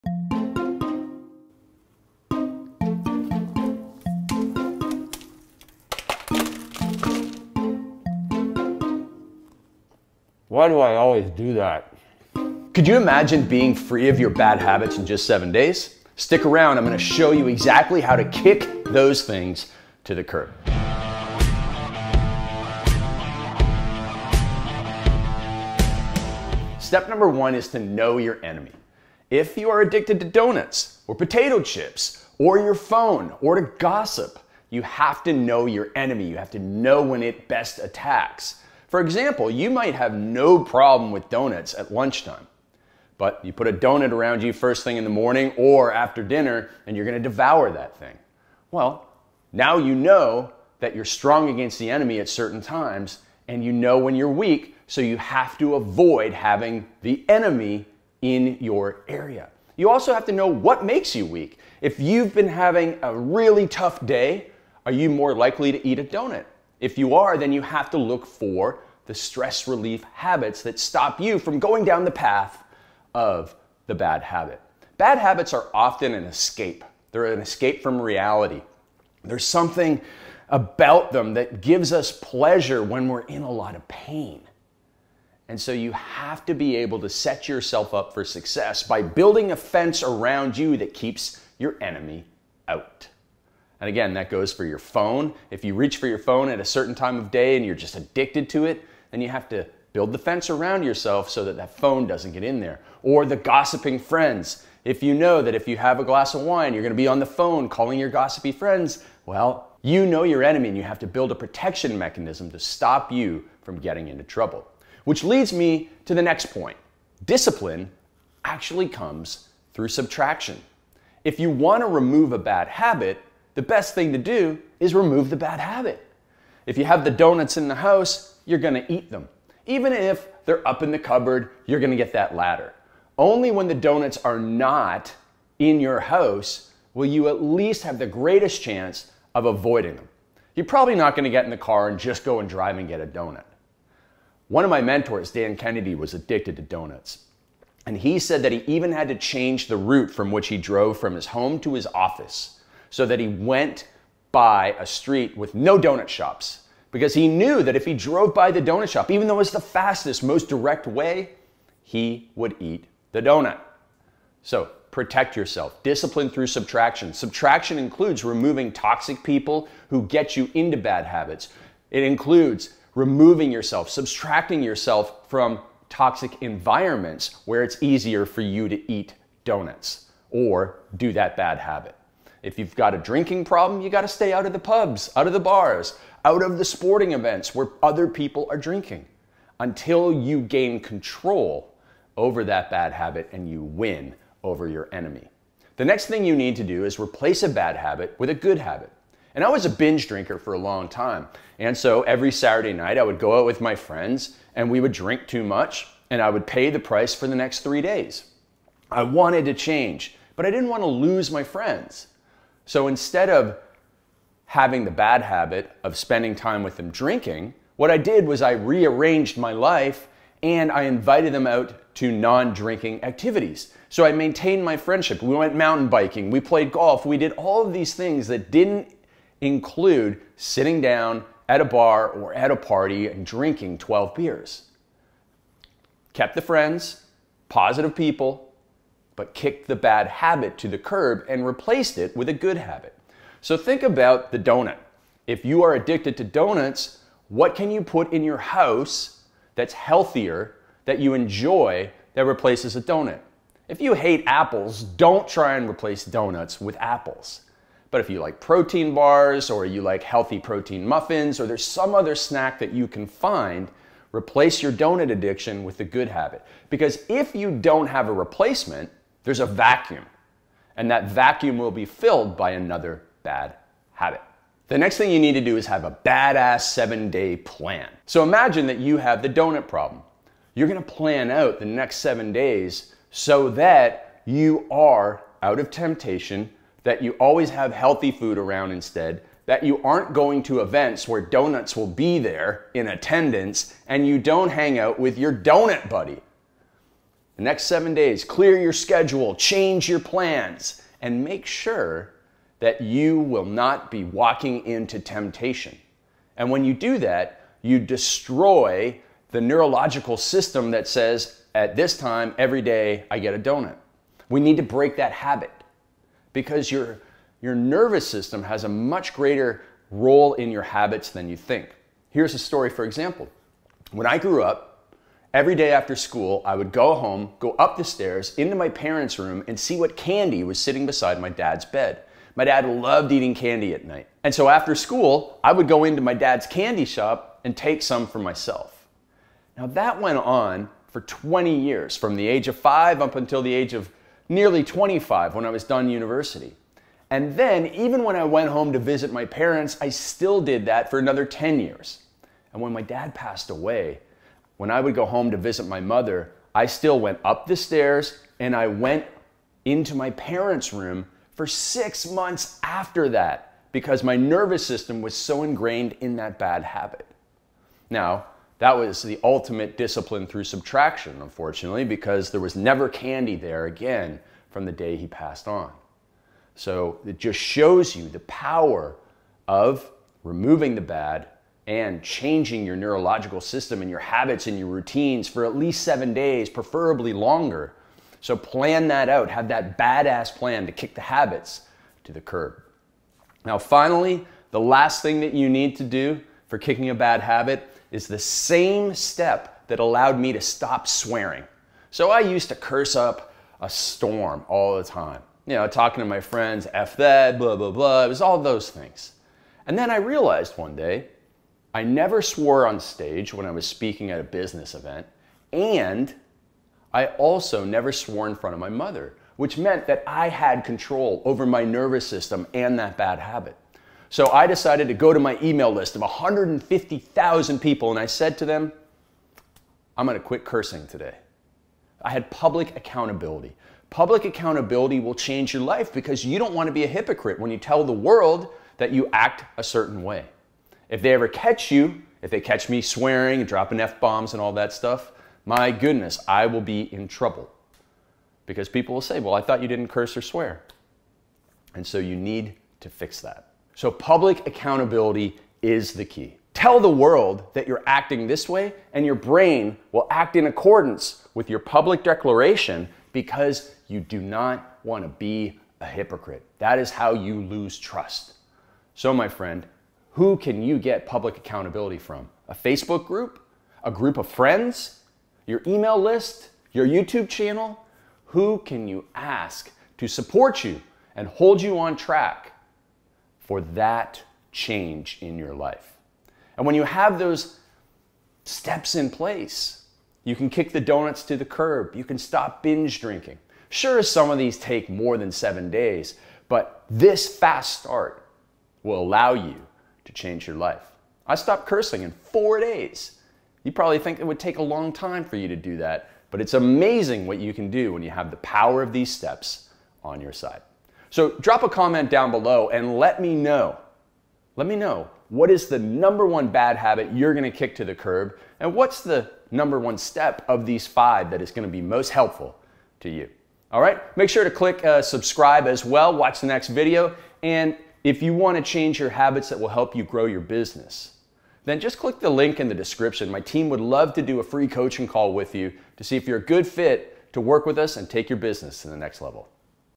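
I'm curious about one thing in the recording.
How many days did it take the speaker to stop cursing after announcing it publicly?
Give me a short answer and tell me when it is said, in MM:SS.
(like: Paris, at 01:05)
4, at 08:22.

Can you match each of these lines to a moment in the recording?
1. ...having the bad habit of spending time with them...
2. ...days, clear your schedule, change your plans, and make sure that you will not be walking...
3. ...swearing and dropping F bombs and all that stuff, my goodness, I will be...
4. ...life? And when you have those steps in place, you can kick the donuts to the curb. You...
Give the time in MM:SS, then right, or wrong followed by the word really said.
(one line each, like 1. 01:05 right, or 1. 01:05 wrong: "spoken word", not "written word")
1. 03:34 right
2. 04:57 right
3. 07:22 right
4. 08:05 right.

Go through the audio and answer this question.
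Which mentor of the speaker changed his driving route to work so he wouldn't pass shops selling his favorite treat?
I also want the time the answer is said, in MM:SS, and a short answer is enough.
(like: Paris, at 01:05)
Dan Kennedy, at 02:25.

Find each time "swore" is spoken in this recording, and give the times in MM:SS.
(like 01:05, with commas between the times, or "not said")
06:52, 06:57.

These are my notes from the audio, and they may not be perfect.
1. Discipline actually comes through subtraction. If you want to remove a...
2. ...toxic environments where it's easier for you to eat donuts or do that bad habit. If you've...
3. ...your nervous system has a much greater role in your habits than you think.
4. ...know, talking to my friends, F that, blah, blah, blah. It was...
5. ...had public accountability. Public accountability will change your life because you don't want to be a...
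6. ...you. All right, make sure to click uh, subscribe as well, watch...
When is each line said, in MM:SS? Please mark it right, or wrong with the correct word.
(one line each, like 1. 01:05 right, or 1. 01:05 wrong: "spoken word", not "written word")
1. 01:57 right
2. 02:55 right
3. 05:17 right
4. 06:45 right
5. 07:12 right
6. 08:43 right.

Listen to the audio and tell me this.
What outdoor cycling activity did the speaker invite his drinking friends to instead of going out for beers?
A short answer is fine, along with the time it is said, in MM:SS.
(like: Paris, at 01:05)
Mountain biking, at 03:45.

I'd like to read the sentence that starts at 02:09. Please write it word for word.
Even if they're up in the cupboard, you're gonna get that ladder.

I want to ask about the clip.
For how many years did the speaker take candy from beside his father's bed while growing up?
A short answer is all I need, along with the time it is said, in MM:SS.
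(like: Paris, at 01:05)
20, at 05:40.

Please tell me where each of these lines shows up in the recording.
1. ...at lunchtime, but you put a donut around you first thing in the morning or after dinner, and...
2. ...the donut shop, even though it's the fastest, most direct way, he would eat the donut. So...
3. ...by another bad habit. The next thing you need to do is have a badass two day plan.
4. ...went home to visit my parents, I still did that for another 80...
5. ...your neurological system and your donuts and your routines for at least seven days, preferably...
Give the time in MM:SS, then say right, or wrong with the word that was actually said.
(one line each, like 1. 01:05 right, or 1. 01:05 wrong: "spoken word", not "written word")
1. 00:41 right
2. 02:38 right
3. 04:32 wrong: "seven", not "two"
4. 05:48 wrong: "10", not "80"
5. 06:22 wrong: "habits", not "donuts".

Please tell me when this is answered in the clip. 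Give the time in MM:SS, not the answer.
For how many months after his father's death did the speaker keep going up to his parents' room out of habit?
06:01.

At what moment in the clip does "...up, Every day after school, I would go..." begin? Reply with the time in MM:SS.
05:24.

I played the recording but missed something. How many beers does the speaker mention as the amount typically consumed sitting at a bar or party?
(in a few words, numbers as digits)
12.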